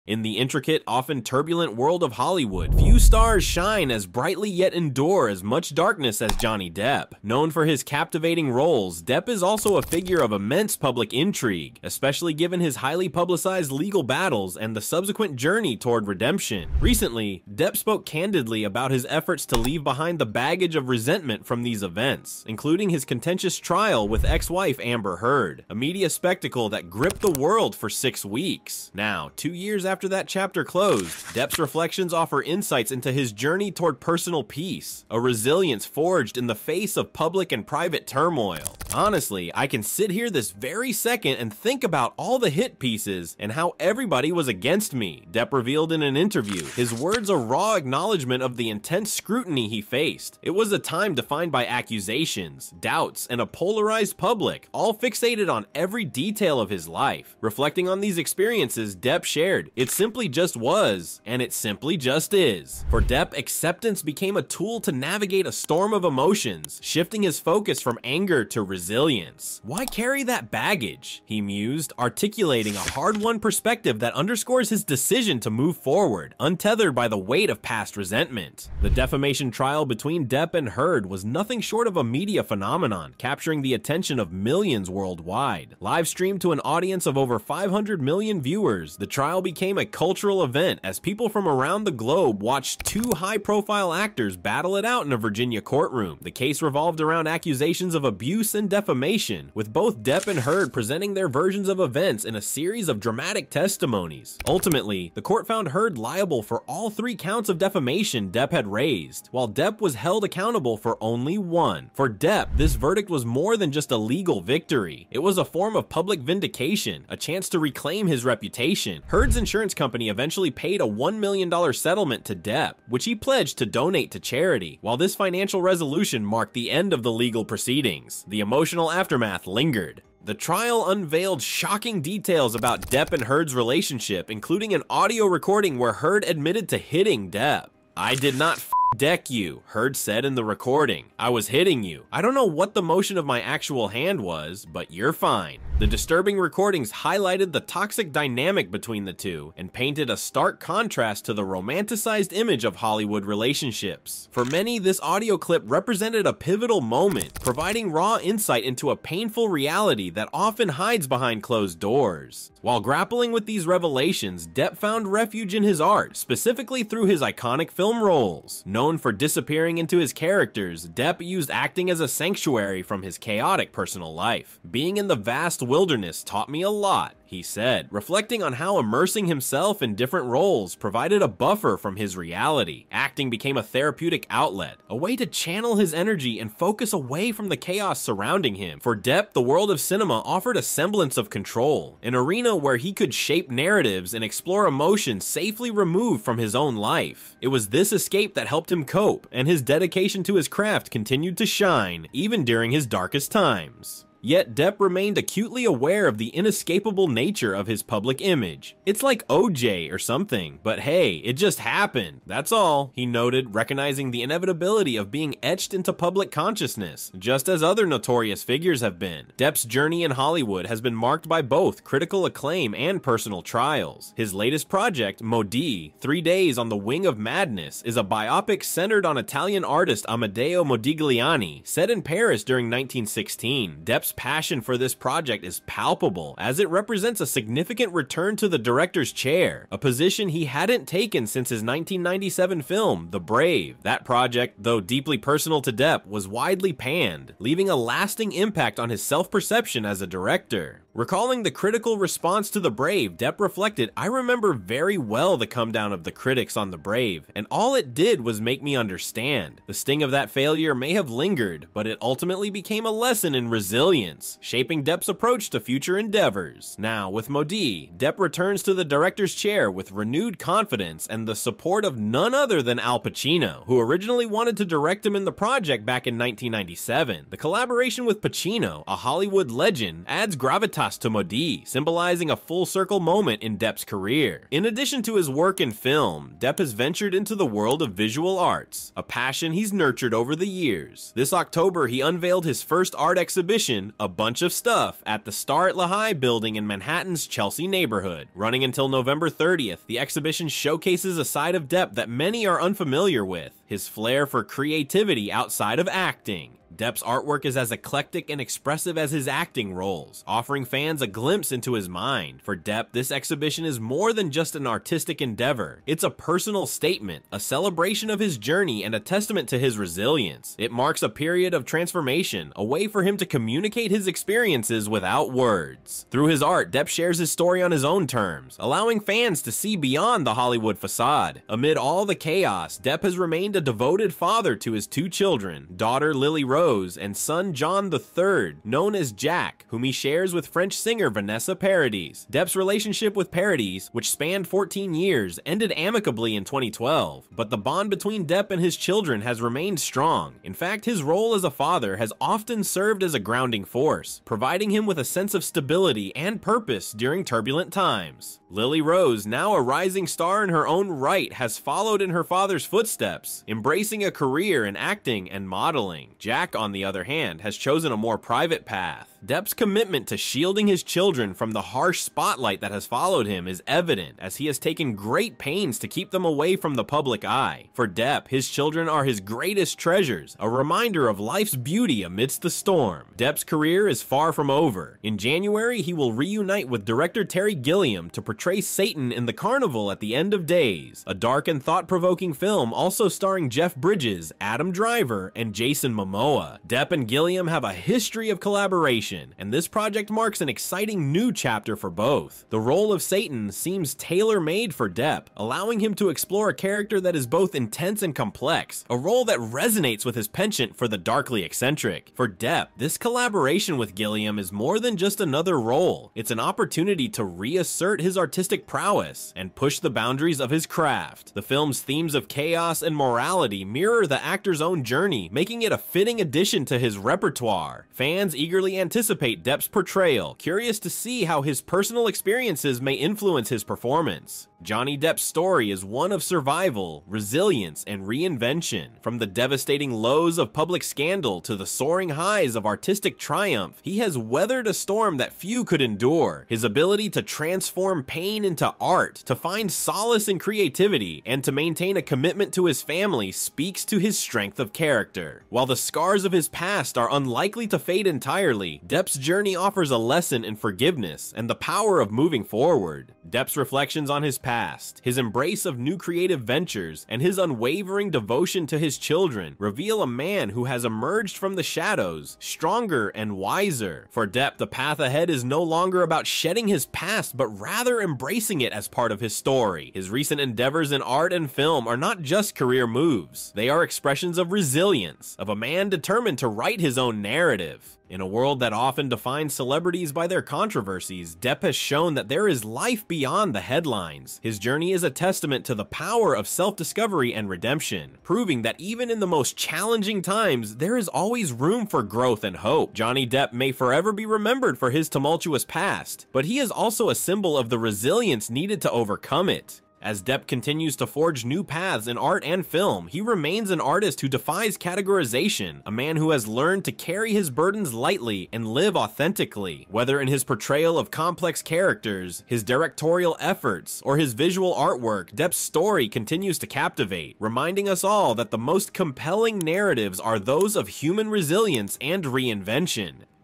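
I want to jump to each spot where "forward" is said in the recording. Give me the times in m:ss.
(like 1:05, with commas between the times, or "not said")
1:15, 7:42.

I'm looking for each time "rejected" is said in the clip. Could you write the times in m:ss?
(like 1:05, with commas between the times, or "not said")
not said.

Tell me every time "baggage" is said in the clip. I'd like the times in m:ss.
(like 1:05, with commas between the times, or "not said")
0:20, 1:10.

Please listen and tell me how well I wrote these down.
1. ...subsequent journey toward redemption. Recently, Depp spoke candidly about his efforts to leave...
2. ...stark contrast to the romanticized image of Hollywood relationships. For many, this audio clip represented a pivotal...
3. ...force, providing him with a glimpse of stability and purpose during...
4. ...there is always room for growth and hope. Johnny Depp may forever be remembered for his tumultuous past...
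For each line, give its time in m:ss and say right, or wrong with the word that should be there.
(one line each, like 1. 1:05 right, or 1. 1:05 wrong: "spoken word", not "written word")
1. 0:14 right
2. 2:30 right
3. 5:53 wrong: "sense", not "glimpse"
4. 8:20 right.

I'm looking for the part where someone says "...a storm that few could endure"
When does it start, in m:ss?
7:24.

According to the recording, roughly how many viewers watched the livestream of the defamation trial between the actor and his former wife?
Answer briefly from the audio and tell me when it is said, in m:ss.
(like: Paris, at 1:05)
over 500 million, at 1:27.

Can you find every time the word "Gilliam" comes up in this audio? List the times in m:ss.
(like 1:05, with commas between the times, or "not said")
6:27, 6:37, 6:53.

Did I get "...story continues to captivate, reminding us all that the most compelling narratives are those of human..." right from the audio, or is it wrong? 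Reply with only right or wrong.
right.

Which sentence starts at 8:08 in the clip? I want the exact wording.
In a world that often defines celebrities by their controversies, Depp has shown that there is life beyond the headlines.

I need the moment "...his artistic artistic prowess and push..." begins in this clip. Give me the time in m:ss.
6:58.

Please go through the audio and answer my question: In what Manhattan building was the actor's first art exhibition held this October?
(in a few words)
Starrett-Lehigh building.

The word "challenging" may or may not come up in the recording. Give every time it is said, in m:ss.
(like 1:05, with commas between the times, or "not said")
8:19.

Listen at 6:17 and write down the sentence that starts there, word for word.
For Depp, his children are his greatest treasures, a reminder of life's beauty amidst the storm.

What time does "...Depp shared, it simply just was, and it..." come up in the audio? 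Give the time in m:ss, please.
0:58.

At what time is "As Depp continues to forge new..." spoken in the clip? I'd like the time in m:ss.
8:30.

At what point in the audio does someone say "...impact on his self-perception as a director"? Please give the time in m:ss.
4:08.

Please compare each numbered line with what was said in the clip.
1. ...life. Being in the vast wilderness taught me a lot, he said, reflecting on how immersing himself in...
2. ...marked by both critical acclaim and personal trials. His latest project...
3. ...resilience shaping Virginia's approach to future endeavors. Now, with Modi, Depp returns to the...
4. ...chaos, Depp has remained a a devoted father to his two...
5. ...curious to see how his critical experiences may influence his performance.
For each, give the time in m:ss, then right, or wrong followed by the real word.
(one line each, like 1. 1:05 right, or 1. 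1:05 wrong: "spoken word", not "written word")
1. 2:54 right
2. 3:40 right
3. 4:23 wrong: "Depp", not "Virginia"
4. 5:32 right
5. 7:10 wrong: "personal", not "critical".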